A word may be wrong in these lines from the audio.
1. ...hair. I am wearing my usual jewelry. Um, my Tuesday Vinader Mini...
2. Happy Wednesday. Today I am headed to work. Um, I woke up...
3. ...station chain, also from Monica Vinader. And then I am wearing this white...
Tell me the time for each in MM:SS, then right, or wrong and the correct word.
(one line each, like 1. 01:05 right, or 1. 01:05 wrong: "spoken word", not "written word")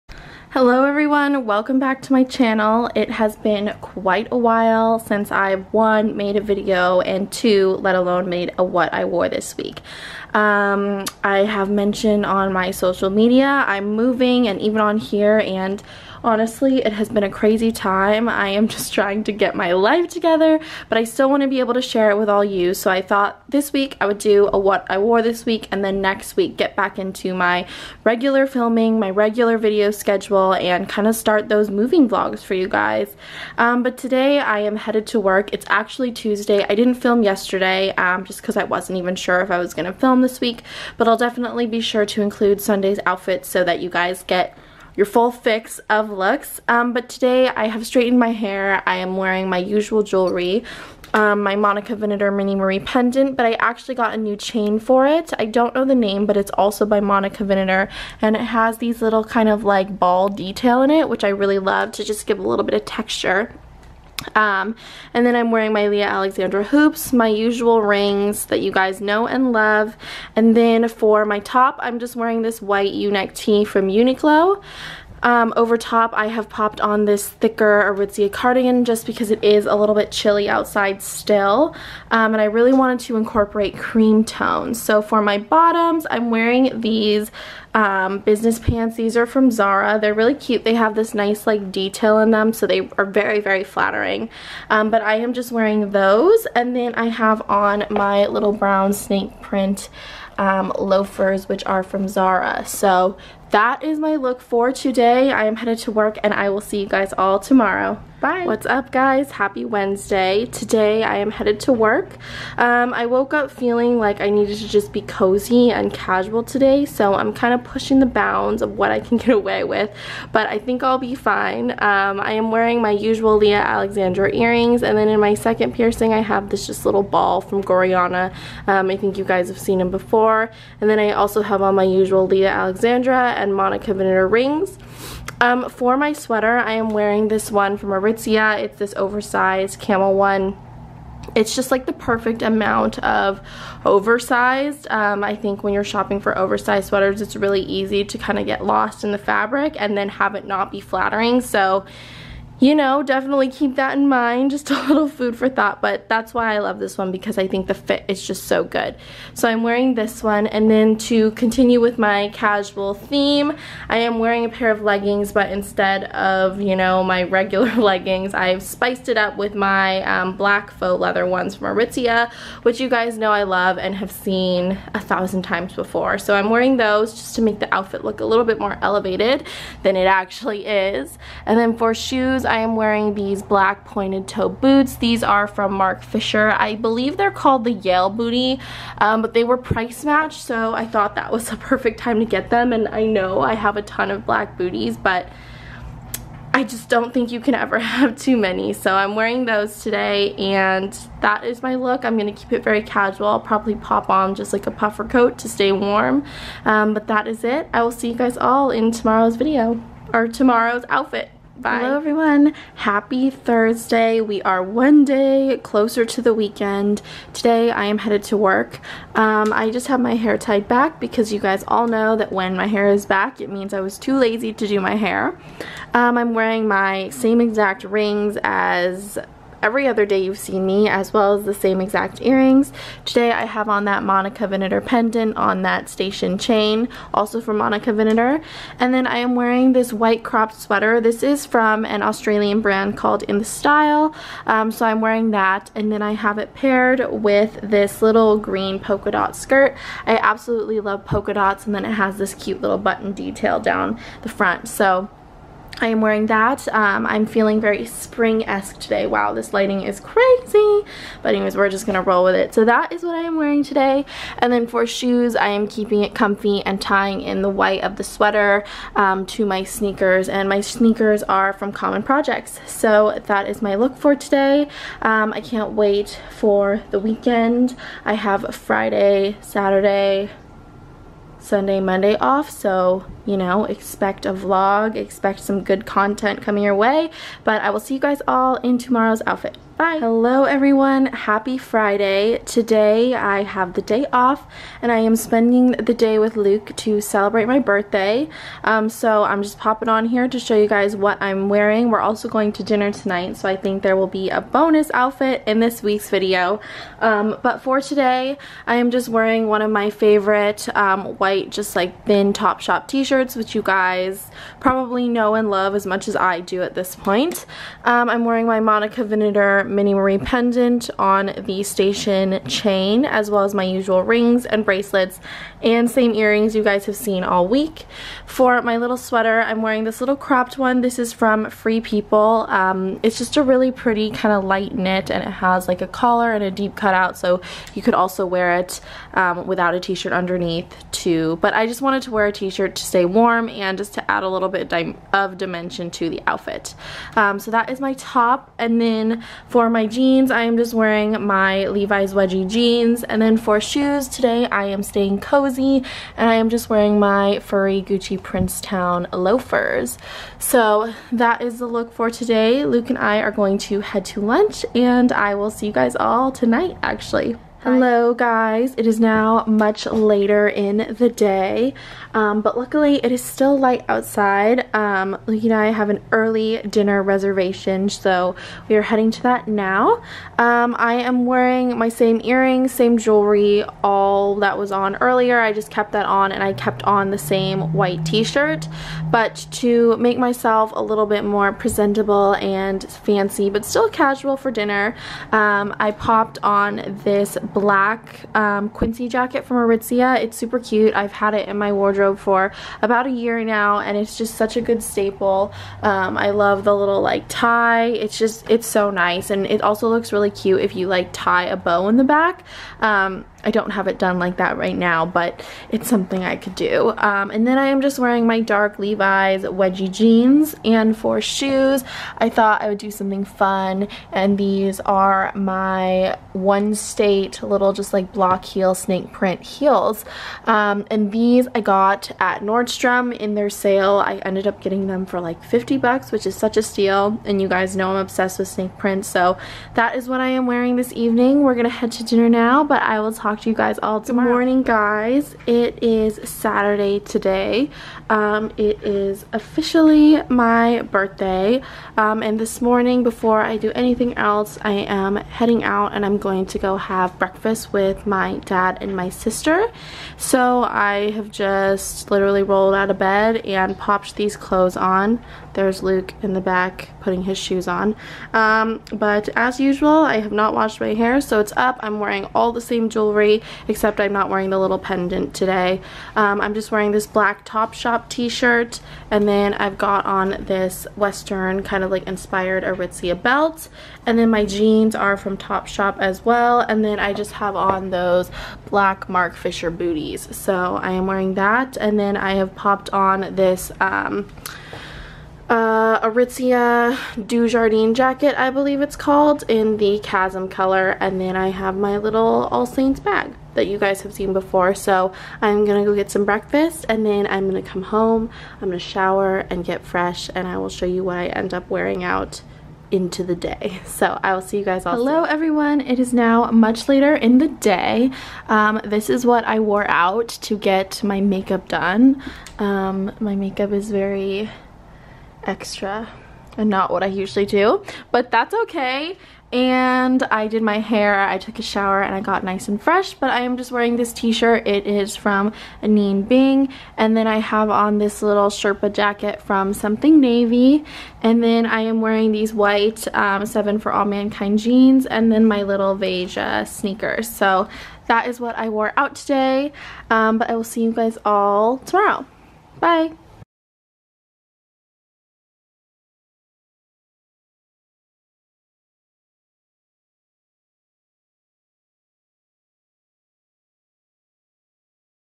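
1. 00:48 wrong: "Monica", not "Tuesday"
2. 01:49 right
3. 03:55 right.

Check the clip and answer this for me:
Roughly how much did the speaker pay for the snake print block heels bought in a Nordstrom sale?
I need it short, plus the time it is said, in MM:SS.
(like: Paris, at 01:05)
$50, at 07:15.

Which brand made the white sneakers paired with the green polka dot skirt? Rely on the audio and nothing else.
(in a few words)
Common Projects.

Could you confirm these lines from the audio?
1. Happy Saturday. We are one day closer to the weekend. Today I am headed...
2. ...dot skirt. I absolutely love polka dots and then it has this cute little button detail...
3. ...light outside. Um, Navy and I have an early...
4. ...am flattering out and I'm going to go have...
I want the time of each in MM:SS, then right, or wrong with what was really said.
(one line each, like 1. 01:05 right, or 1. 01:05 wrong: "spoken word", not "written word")
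1. 03:32 wrong: "Thursday", not "Saturday"
2. 04:09 right
3. 06:13 wrong: "Luke", not "Navy"
4. 07:34 wrong: "heading", not "flattering".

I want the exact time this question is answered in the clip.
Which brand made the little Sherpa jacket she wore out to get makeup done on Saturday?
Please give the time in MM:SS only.
08:59.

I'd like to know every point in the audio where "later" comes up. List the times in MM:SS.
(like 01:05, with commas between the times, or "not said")
06:09, 08:36.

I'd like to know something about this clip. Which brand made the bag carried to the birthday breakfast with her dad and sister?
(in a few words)
All Saints.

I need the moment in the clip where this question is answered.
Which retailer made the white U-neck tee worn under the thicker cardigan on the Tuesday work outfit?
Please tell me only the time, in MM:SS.
01:13.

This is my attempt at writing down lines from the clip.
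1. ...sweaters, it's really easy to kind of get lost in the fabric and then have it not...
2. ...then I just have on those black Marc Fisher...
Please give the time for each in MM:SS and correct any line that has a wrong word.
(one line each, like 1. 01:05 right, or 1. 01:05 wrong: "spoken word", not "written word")
1. 02:26 right
2. 08:06 right.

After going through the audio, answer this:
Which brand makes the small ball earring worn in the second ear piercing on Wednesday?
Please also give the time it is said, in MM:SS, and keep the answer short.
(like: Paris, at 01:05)
Gorjana, at 02:07.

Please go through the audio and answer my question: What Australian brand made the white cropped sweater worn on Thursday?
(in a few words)
In The Style.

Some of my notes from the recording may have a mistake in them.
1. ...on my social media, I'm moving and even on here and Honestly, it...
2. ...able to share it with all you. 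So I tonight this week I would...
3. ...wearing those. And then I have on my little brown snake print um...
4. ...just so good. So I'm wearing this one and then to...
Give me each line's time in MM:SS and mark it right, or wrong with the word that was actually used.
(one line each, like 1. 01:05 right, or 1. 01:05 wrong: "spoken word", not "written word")
1. 00:12 right
2. 00:21 wrong: "thought", not "tonight"
3. 01:35 right
4. 02:38 right.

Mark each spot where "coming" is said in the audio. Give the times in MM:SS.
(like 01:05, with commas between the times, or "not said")
04:46.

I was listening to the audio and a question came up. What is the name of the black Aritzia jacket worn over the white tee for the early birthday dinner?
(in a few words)
Quincey jacket.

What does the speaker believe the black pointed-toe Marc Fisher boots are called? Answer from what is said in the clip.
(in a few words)
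Yale Booty.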